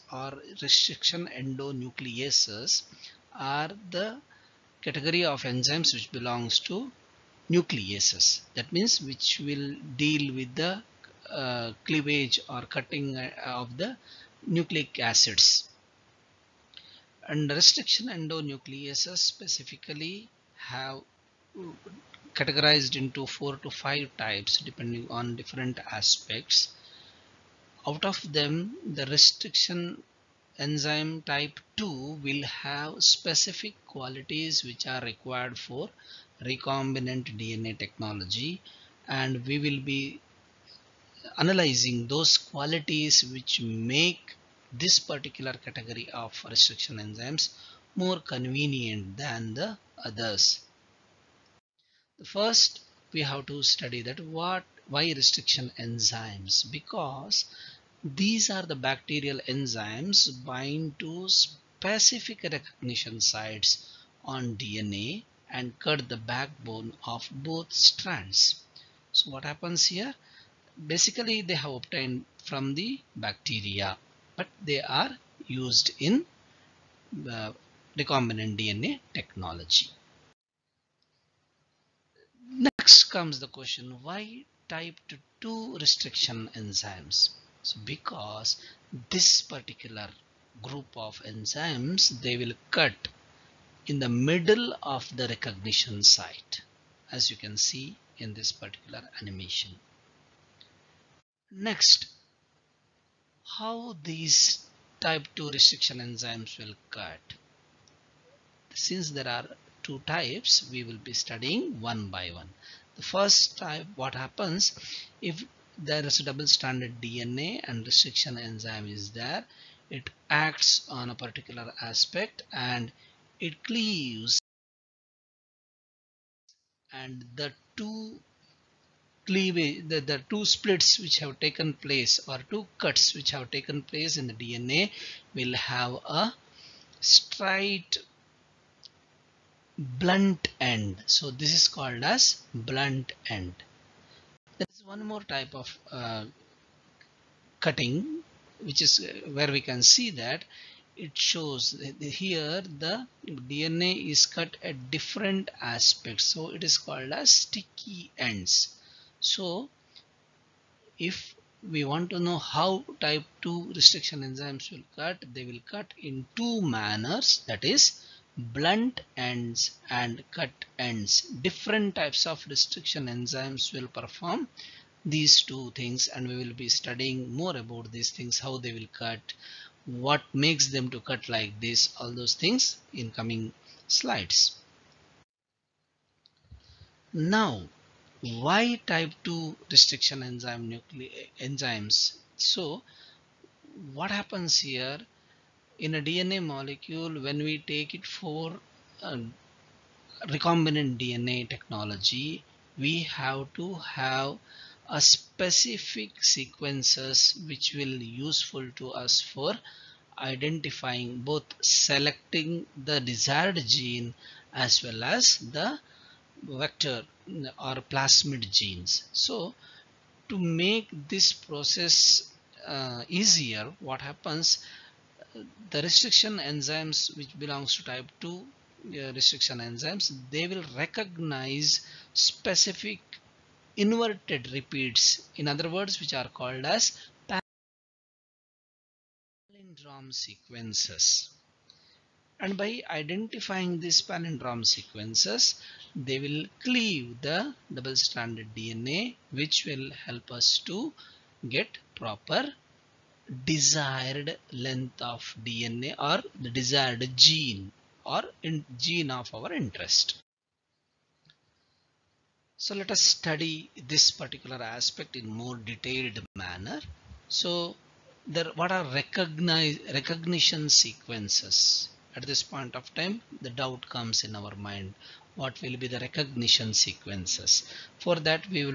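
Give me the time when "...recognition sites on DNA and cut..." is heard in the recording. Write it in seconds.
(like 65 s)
62 s.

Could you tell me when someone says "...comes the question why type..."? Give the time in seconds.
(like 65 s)
83 s.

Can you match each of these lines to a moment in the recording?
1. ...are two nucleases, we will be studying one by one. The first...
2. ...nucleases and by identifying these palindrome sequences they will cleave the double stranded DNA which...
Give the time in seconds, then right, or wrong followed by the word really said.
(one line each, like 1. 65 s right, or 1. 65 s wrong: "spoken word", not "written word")
1. 109 s wrong: "types", not "nucleases"
2. 240 s wrong: "sequences", not "nucleases".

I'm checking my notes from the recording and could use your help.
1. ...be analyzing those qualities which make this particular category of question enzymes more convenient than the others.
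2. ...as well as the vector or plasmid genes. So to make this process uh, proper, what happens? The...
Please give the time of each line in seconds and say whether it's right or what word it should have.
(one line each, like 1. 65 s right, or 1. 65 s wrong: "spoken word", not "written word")
1. 39 s wrong: "restriction", not "question"
2. 214 s wrong: "easier", not "proper".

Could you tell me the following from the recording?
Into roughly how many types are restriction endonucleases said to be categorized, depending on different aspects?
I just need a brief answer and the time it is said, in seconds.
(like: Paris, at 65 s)
4 to 5, at 23 s.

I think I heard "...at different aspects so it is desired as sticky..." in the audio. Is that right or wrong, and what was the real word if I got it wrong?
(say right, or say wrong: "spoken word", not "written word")
wrong: "called", not "desired".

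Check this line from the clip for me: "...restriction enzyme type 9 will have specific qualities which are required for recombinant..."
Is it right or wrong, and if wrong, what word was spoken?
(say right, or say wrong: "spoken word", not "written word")
wrong: "2", not "9".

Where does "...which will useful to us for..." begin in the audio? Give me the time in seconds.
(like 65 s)
207 s.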